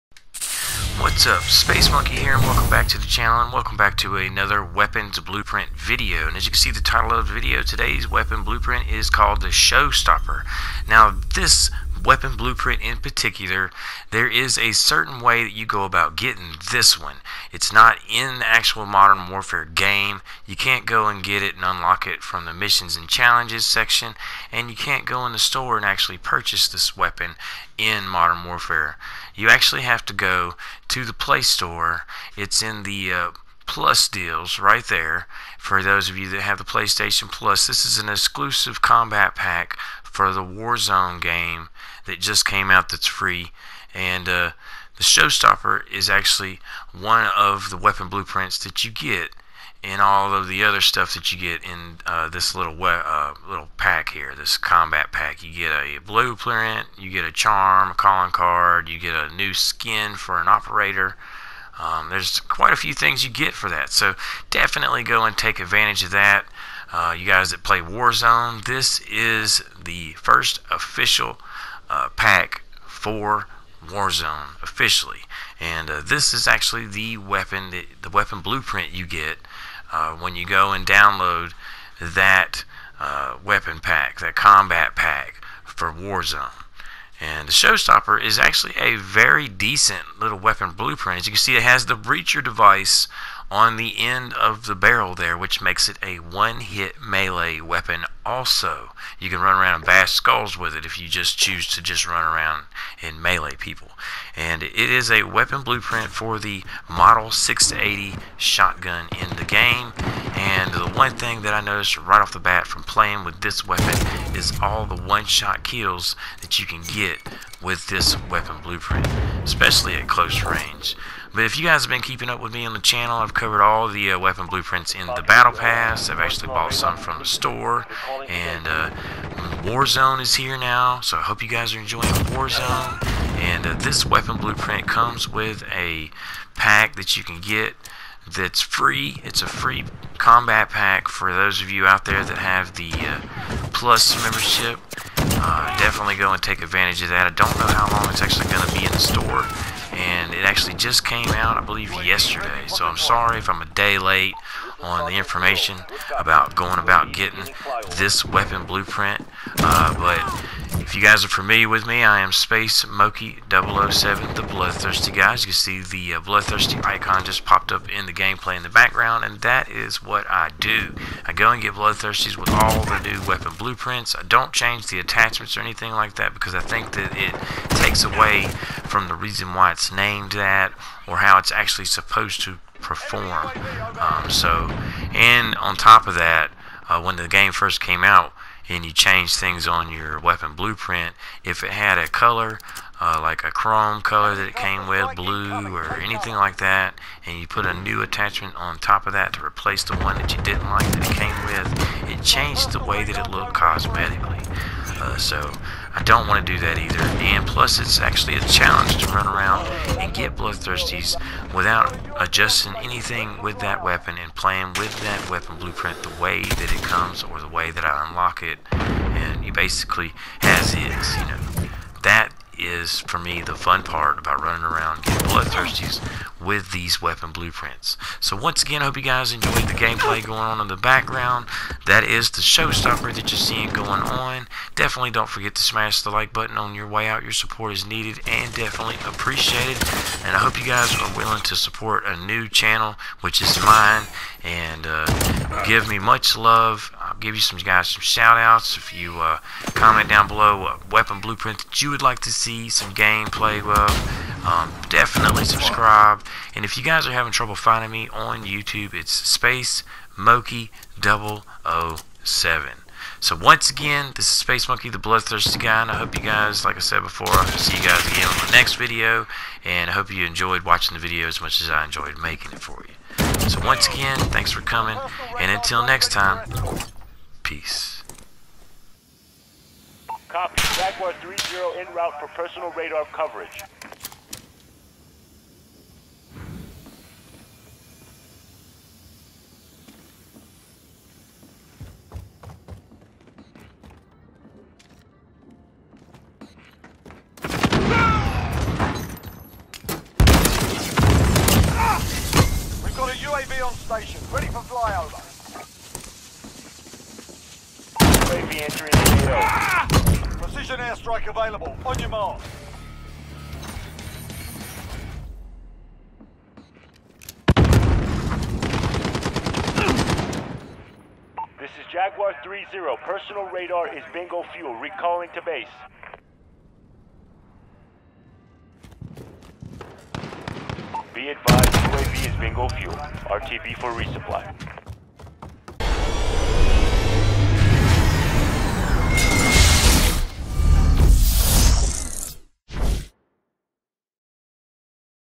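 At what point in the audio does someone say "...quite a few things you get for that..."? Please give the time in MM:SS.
01:02.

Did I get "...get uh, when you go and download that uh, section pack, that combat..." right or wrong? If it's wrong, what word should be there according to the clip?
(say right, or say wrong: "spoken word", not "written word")
wrong: "weapon", not "section".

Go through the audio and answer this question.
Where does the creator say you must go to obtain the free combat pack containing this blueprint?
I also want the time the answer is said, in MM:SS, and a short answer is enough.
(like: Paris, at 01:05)
Play Store, at 00:31.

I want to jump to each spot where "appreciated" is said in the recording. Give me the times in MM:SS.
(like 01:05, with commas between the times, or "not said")
03:59.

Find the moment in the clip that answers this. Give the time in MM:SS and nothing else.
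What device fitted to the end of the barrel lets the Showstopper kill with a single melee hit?
01:31.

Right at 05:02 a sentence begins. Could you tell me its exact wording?
We've got a UAV on station, ready for flyover.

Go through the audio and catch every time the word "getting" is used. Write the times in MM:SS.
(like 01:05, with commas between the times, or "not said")
00:16, 02:37, 03:45.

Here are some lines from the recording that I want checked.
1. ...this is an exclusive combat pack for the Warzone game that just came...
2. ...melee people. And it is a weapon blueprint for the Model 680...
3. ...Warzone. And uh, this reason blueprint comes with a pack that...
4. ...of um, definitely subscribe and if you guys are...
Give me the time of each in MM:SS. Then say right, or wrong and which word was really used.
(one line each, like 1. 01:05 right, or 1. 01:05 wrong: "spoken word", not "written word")
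1. 00:37 right
2. 01:43 right
3. 02:12 wrong: "weapon", not "reason"
4. 04:13 right.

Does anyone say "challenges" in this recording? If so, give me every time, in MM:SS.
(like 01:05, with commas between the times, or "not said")
00:23, 03:28.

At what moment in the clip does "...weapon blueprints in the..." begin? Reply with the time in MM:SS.
02:04.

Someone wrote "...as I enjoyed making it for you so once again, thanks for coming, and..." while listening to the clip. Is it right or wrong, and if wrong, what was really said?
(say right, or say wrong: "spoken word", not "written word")
right.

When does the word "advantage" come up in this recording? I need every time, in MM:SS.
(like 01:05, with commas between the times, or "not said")
01:05, 02:26.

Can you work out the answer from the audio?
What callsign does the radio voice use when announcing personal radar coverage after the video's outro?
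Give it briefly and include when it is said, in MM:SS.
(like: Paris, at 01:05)
Jaguar 3-0, at 04:40.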